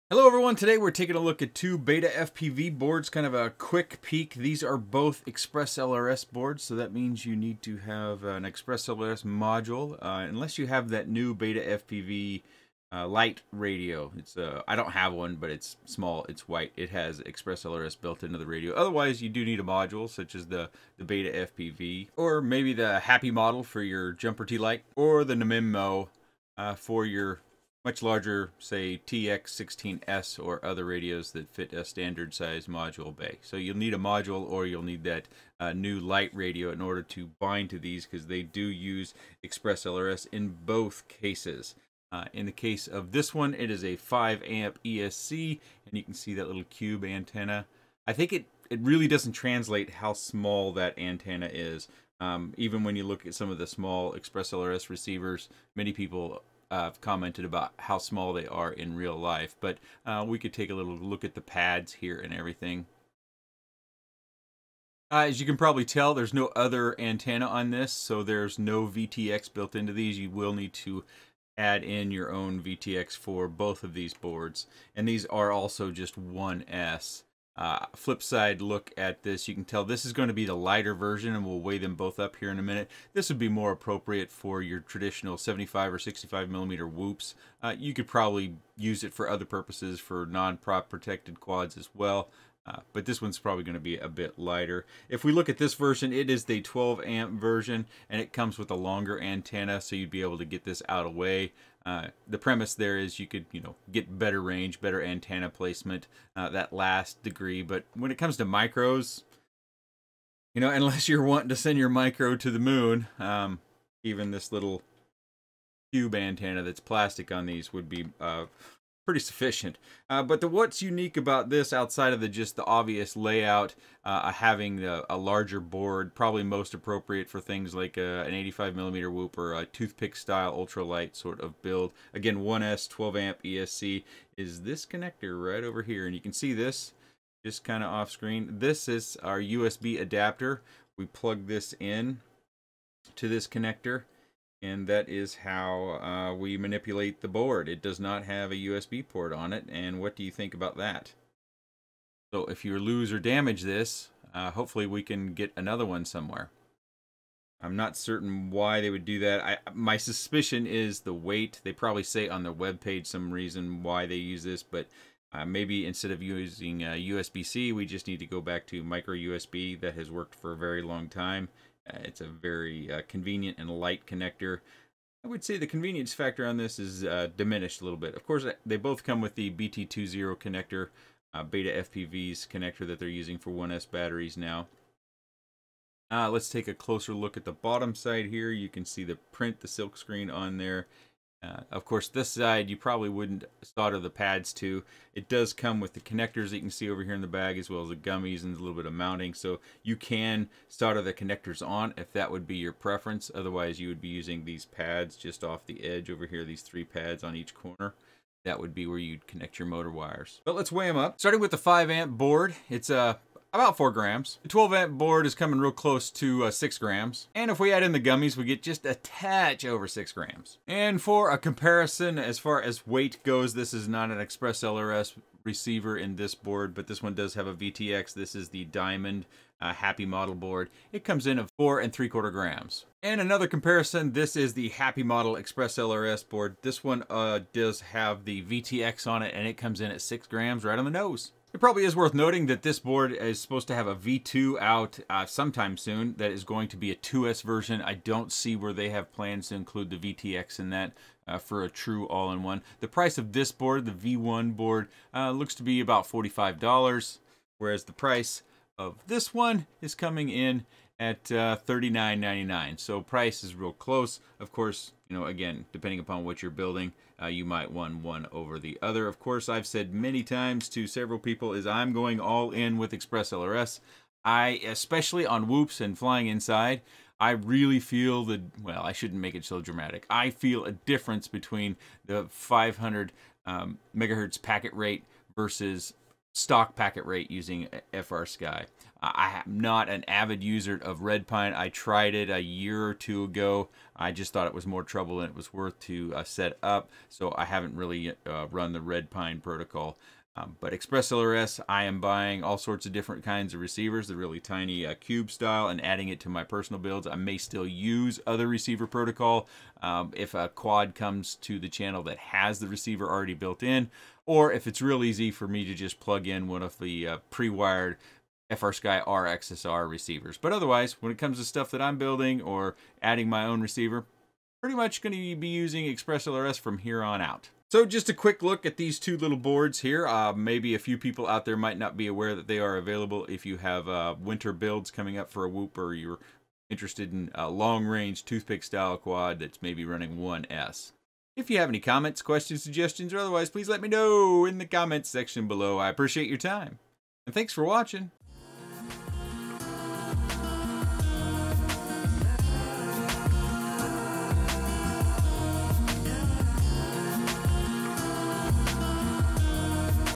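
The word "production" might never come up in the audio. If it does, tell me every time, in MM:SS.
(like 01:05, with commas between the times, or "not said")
not said.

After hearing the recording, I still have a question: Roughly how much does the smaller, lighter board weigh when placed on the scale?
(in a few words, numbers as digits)
4 grams.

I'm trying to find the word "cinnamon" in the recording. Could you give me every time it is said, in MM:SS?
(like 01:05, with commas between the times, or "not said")
not said.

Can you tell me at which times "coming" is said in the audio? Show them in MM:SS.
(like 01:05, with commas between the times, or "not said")
03:35, 04:19, 05:34.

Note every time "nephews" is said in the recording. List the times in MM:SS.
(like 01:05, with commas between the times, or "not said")
not said.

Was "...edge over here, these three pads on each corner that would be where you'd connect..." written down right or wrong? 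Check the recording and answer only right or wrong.
right.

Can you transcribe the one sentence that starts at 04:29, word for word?
Of course, I've said many times to several people is I'm going all in with Express LRS.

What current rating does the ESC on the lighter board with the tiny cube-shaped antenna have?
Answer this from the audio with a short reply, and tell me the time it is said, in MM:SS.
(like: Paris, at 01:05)
5 amp, at 00:43.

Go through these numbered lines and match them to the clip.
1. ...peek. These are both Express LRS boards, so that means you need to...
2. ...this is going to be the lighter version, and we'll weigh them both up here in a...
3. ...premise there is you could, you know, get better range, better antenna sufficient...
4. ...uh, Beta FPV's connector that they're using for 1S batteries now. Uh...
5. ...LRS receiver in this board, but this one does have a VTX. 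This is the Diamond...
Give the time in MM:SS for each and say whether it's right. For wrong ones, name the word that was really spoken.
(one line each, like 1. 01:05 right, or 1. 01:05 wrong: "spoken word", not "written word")
1. 00:04 right
2. 01:19 right
3. 01:42 wrong: "placement", not "sufficient"
4. 03:01 right
5. 03:44 right.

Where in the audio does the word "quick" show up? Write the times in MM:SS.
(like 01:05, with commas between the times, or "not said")
00:03, 05:28.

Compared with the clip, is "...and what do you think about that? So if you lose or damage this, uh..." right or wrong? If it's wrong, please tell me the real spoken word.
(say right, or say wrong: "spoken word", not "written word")
right.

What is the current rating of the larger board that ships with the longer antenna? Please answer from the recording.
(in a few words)
12 amp.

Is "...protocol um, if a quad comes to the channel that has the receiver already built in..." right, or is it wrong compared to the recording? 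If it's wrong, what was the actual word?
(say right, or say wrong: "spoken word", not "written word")
right.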